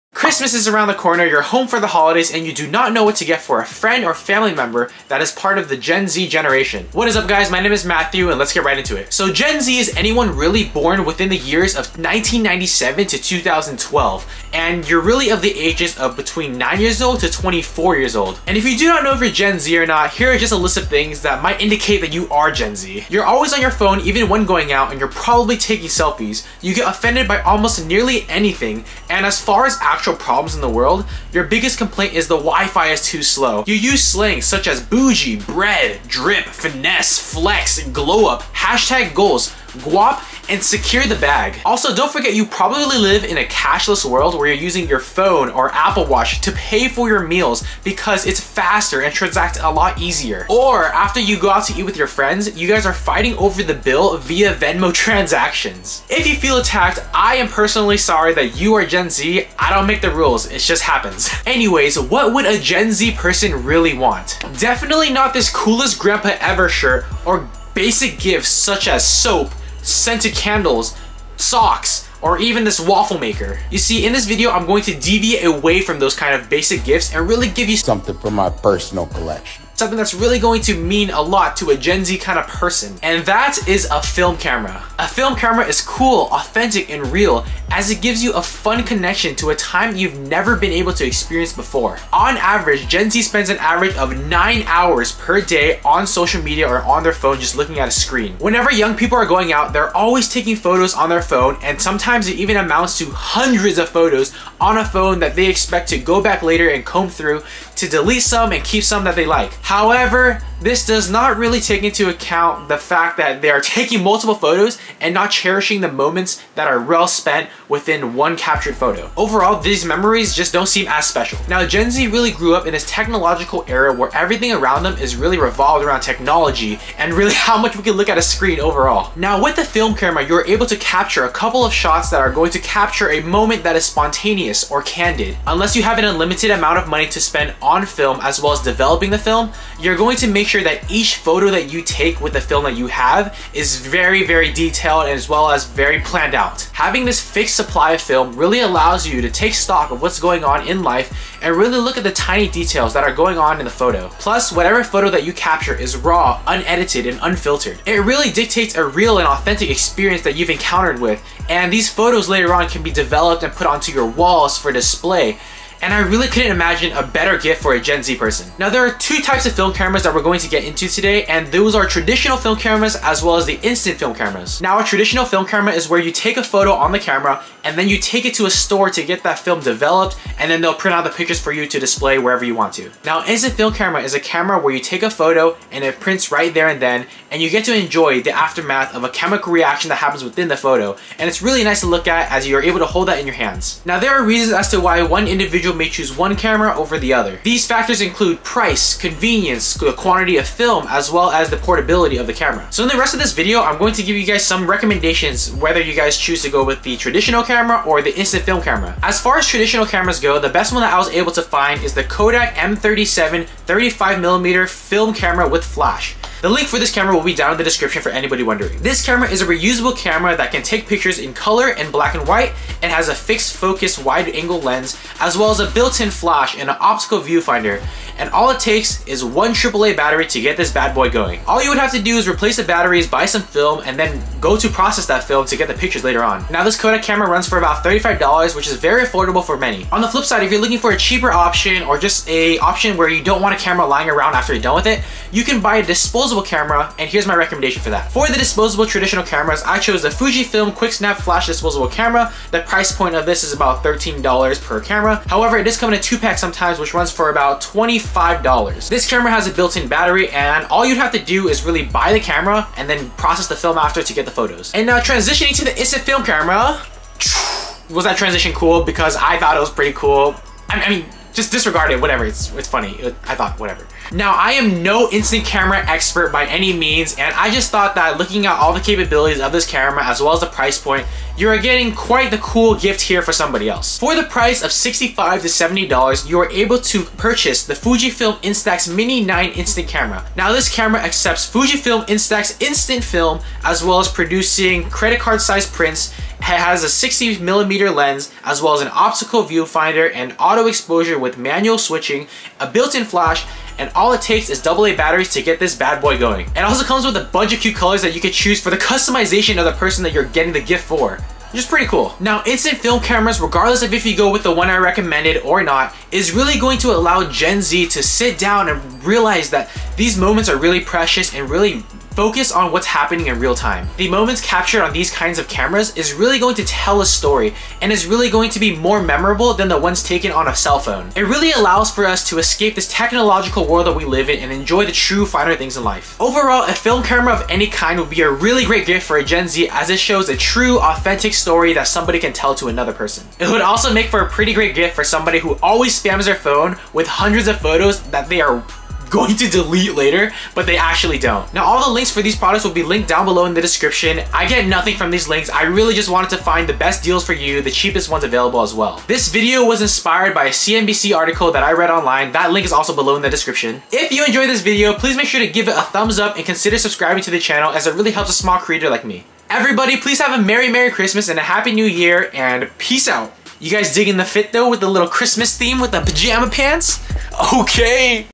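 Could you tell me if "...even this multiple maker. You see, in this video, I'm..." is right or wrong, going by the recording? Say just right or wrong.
wrong.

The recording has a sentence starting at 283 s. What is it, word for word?
For the price of $65 to $70, you are able to purchase the Fujifilm Instax Mini 9 instant camera.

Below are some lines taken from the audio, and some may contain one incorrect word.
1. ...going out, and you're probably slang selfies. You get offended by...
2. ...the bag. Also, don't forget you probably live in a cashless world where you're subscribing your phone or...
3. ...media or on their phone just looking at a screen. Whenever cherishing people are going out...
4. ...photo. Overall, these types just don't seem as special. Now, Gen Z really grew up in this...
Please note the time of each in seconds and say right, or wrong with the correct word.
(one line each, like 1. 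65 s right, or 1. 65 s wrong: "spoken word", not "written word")
1. 24 s wrong: "taking", not "slang"
2. 41 s wrong: "using", not "subscribing"
3. 96 s wrong: "young", not "cherishing"
4. 118 s wrong: "memories", not "types".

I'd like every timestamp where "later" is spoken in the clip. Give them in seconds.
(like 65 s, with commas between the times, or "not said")
106 s, 162 s, 236 s, 349 s.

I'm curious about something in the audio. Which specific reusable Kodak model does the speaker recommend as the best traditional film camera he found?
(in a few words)
Kodak M37.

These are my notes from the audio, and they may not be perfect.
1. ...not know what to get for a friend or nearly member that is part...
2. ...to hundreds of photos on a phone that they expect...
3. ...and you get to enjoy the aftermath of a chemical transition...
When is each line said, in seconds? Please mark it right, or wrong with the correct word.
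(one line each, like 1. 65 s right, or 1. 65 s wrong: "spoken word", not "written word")
1. 2 s wrong: "family", not "nearly"
2. 102 s right
3. 187 s wrong: "reaction", not "transition".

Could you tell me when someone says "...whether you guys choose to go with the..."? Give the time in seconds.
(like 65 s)
205 s.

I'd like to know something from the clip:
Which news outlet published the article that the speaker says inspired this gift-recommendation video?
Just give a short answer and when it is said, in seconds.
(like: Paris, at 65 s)
CNBC, at 360 s.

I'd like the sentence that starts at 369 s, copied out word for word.
Everybody, please have a Merry Merry Christmas and a Happy New Year and peace out.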